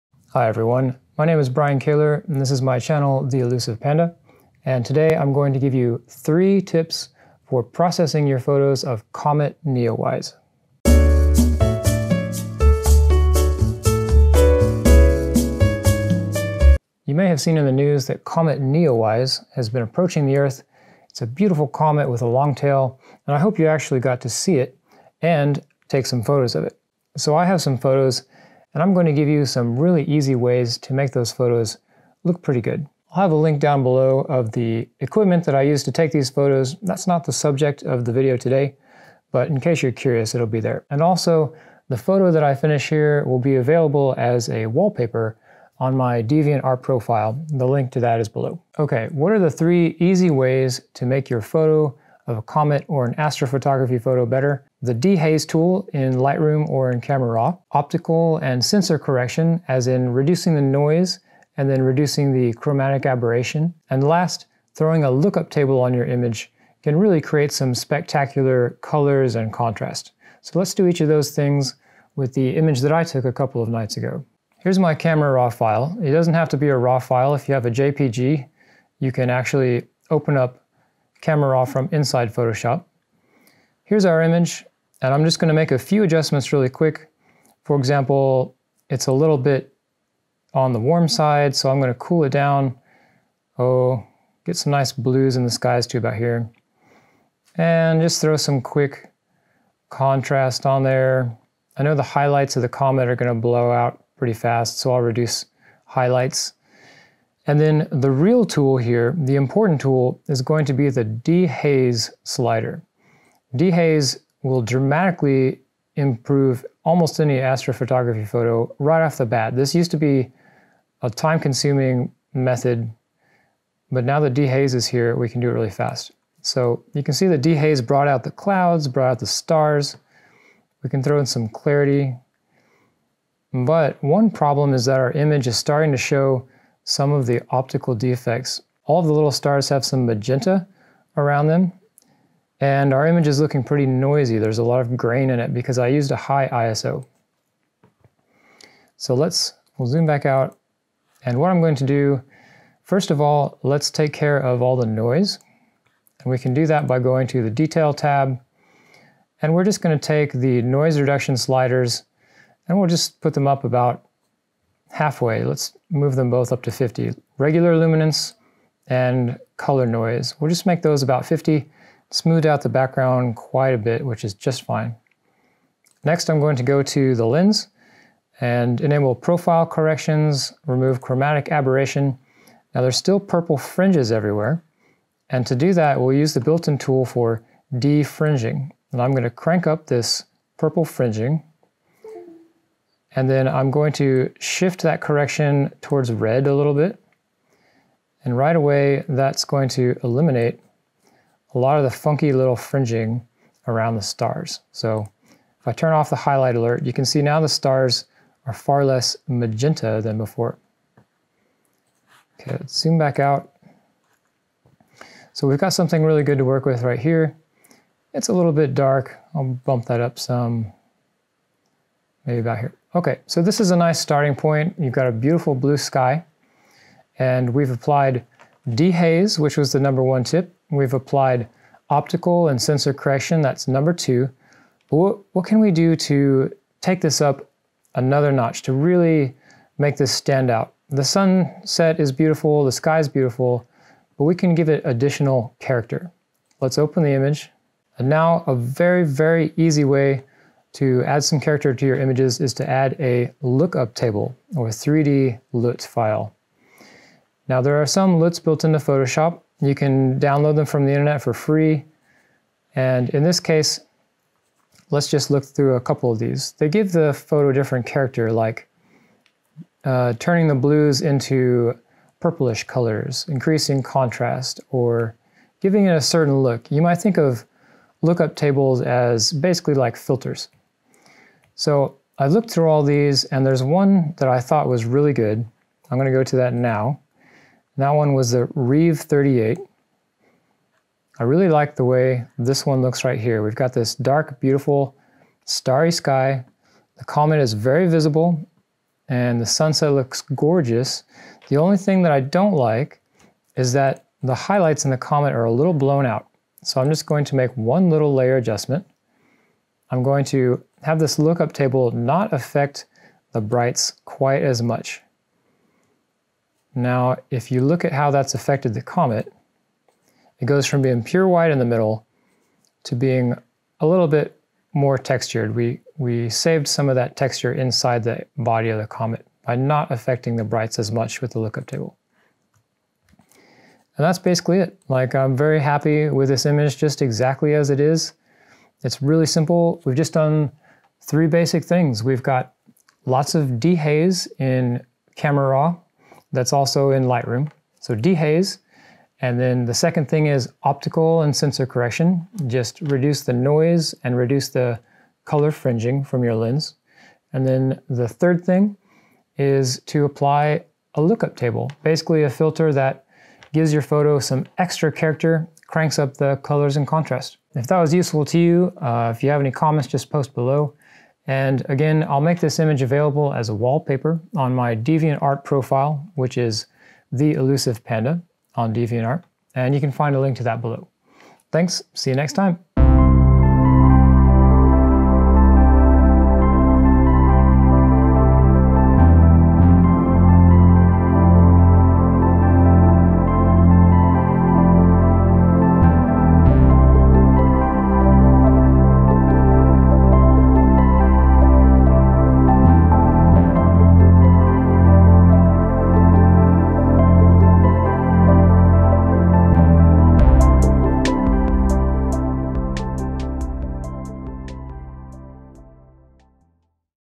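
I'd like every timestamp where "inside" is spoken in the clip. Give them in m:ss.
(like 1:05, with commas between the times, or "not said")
1:21, 5:27.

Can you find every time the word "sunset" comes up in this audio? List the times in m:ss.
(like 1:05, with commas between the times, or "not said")
4:01, 4:59.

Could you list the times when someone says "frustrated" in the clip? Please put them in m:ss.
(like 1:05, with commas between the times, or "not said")
not said.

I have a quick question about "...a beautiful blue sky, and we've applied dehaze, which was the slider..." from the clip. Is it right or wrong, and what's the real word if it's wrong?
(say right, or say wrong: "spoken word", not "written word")
wrong: "number", not "slider".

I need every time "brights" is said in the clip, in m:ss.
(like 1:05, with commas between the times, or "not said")
5:13, 5:30.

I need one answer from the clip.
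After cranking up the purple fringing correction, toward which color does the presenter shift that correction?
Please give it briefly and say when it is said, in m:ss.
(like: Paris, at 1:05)
red, at 3:16.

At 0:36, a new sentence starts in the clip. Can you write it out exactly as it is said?
That's not the subject of the video today, but in case you're curious, it'll be there.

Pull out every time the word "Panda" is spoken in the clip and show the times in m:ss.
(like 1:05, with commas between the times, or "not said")
0:03, 6:17.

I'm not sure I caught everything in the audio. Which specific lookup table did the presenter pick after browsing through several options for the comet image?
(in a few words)
Reeve 38.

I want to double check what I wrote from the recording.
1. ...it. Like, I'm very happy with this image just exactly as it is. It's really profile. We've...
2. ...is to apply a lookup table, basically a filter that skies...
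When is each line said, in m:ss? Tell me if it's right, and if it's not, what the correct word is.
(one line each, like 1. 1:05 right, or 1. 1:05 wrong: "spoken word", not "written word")
1. 5:34 wrong: "simple", not "profile"
2. 5:59 wrong: "gives", not "skies".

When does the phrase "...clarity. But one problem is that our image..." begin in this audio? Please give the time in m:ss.
2:11.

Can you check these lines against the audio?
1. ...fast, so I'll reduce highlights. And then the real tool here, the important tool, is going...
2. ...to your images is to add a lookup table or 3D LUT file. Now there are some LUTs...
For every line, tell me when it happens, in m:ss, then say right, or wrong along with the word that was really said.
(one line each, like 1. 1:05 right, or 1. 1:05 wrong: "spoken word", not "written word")
1. 1:44 right
2. 4:11 right.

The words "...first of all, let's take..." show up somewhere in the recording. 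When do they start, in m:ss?
2:32.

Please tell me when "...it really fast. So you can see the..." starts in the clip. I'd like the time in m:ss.
2:05.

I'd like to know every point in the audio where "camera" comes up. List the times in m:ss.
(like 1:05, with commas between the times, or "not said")
0:57, 1:14, 1:21, 5:45.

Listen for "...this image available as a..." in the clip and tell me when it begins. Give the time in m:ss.
6:12.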